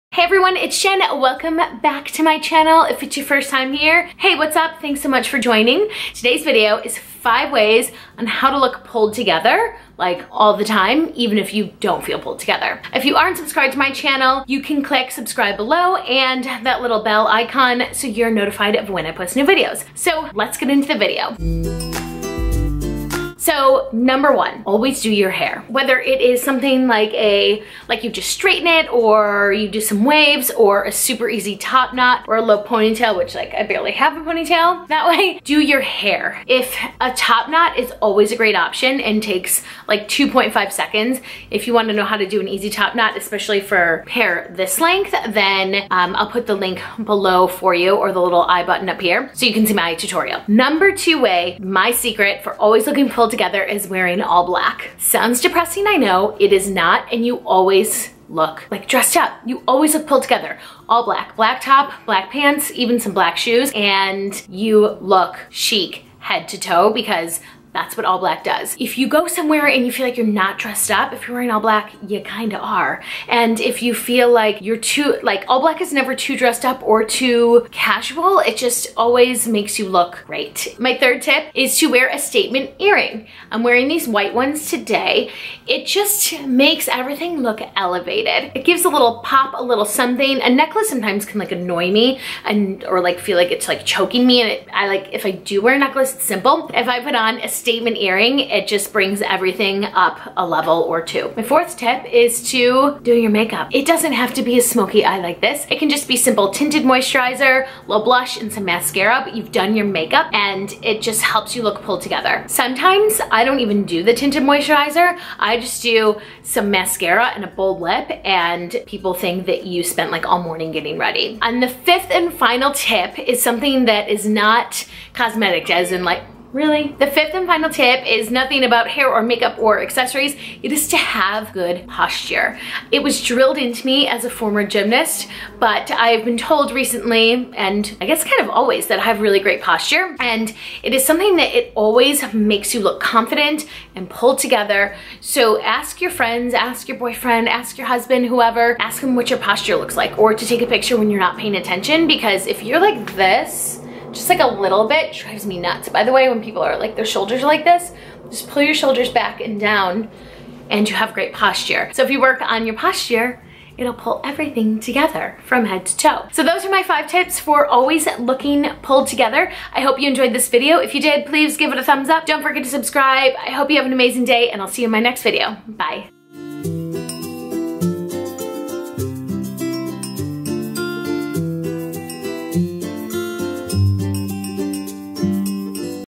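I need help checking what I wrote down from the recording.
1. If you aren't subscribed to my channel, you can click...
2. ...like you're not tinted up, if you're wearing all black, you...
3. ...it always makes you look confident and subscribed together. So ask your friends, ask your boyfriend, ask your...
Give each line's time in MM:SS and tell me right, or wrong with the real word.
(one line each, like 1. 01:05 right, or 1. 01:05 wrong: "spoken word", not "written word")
1. 00:12 right
2. 01:10 wrong: "dressed", not "tinted"
3. 02:21 wrong: "pulled", not "subscribed".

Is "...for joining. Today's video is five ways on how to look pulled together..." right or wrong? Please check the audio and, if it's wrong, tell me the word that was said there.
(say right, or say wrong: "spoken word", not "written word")
right.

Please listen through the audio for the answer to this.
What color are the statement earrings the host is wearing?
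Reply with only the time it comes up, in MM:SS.
01:24.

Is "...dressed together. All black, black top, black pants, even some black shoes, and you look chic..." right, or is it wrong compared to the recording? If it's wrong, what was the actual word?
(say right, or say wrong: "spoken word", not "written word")
wrong: "pulled", not "dressed".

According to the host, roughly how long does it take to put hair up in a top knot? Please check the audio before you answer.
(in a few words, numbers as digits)
2.5 seconds.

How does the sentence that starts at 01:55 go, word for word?
I just do some mascara and a bold lip and people think that you spent like all morning getting ready.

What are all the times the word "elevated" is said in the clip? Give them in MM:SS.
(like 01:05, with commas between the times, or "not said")
01:27.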